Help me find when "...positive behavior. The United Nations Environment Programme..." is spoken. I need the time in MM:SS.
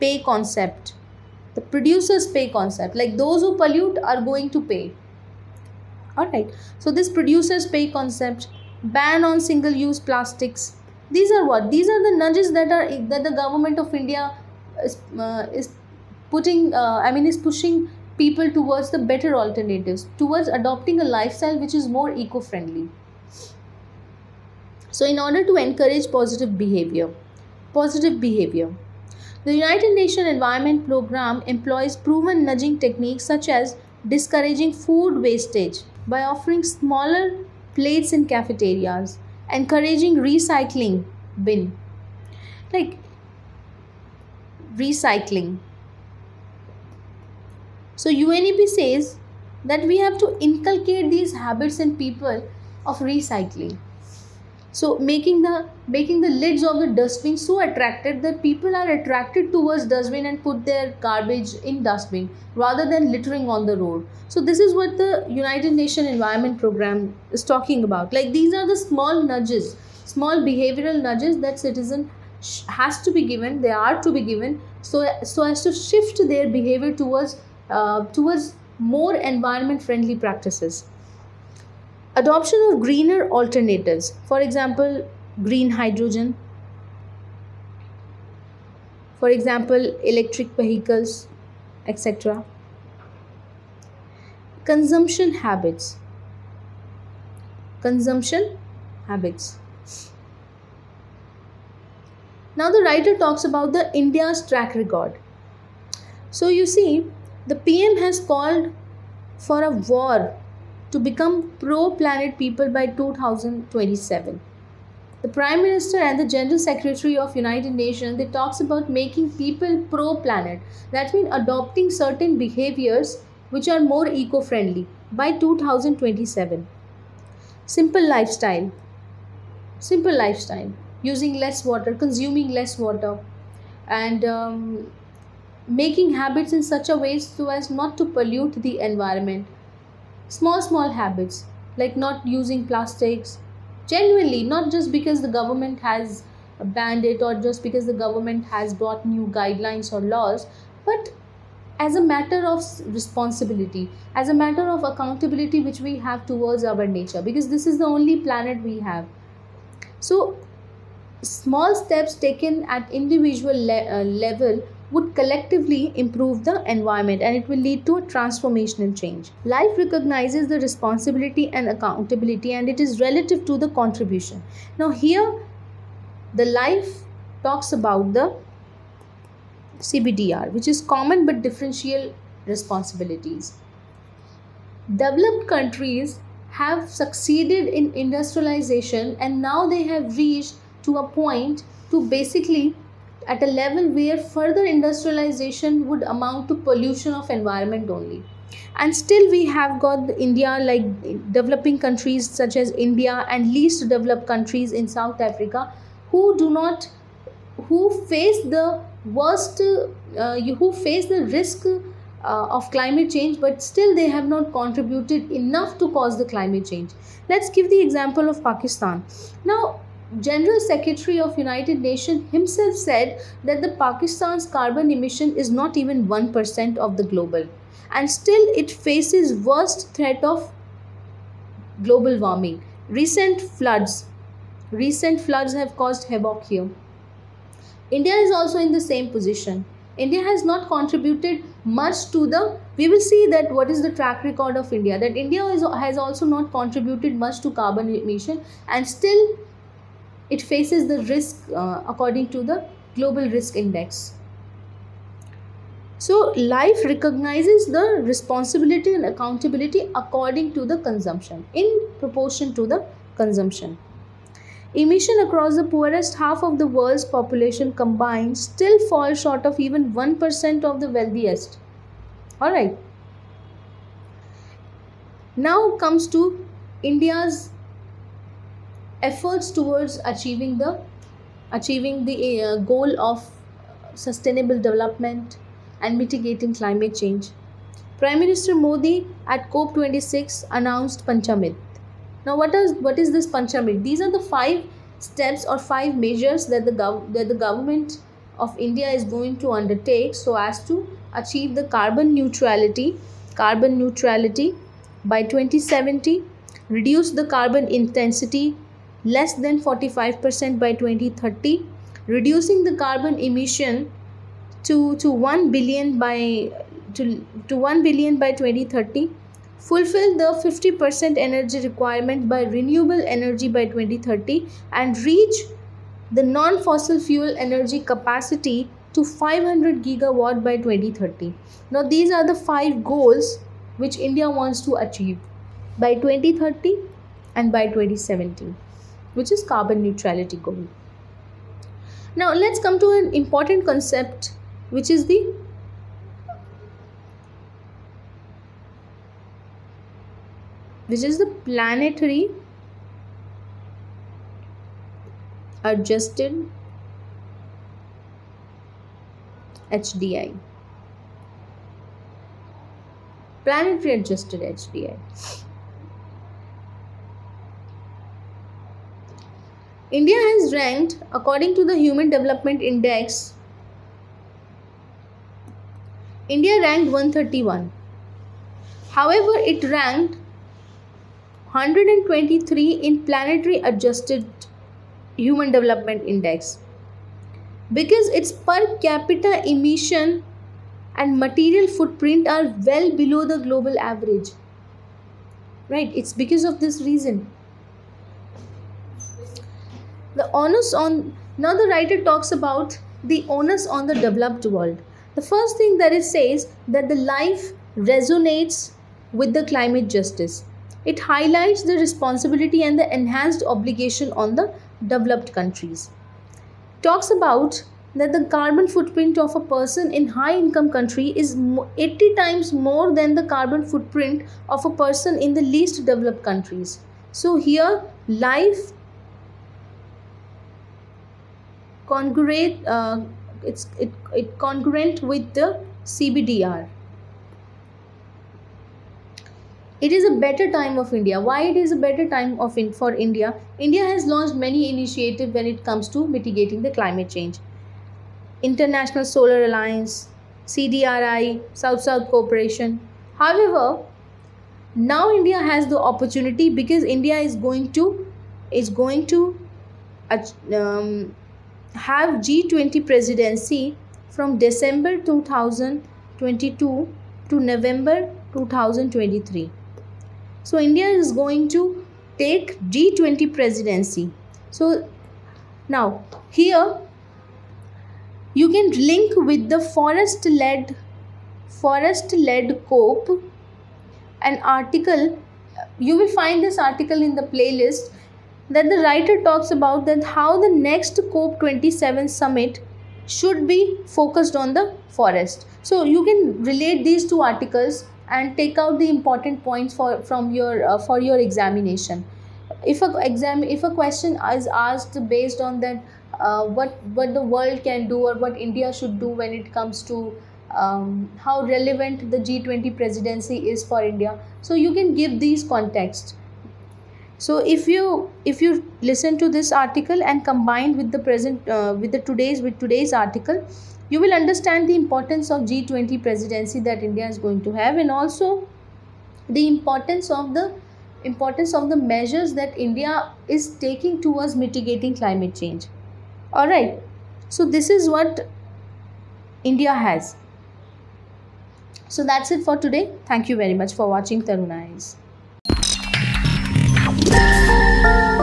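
00:27.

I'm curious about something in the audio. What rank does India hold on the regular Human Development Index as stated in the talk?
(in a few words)
131.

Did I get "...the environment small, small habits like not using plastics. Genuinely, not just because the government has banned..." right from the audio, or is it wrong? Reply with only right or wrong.
right.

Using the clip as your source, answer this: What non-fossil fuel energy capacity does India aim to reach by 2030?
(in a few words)
500 gigawatt.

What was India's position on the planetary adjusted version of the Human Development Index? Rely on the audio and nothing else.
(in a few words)
123.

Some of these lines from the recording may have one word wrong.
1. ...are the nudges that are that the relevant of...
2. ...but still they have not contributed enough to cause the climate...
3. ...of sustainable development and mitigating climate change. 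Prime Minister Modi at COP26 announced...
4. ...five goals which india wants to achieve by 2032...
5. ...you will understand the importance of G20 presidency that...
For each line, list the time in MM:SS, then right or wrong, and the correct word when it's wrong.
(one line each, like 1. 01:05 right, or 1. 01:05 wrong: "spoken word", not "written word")
1. 00:11 wrong: "government", not "relevant"
2. 03:33 right
3. 04:43 right
4. 05:32 wrong: "2030", not "2032"
5. 08:43 right.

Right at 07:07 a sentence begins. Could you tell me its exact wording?
So here life congruent uh, it's it, it congruent with the CBDR.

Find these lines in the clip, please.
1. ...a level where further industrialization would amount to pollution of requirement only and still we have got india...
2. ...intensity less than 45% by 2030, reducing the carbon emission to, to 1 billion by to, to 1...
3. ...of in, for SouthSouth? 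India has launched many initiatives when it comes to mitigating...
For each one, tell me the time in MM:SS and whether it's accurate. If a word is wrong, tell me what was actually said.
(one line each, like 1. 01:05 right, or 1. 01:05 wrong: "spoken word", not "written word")
1. 03:13 wrong: "environment", not "requirement"
2. 05:07 right
3. 07:22 wrong: "India", not "SouthSouth".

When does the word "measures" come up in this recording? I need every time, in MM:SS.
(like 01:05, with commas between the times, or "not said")
04:56, 08:51.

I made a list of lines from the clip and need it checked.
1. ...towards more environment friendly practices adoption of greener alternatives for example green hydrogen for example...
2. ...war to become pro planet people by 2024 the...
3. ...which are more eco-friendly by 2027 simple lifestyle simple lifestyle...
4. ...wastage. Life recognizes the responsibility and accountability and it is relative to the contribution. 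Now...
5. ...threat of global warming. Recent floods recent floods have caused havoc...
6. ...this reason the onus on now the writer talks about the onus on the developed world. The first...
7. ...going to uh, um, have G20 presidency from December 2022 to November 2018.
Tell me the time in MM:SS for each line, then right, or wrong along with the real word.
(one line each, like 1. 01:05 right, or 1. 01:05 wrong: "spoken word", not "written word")
1. 01:18 right
2. 01:49 wrong: "2027", not "2024"
3. 02:03 right
4. 02:48 wrong: "change", not "wastage"
5. 03:49 right
6. 06:36 right
7. 07:38 wrong: "2023", not "2018".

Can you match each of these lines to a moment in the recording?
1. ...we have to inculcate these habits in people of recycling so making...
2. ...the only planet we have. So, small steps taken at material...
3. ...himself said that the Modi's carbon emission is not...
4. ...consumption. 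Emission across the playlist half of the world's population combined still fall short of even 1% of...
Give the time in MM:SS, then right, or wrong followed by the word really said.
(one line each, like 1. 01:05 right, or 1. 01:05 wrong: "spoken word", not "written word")
1. 00:49 right
2. 02:37 wrong: "individual", not "material"
3. 03:42 wrong: "Pakistan", not "Modi"
4. 04:23 wrong: "poorest", not "playlist".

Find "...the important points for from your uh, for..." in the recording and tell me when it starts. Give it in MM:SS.
08:18.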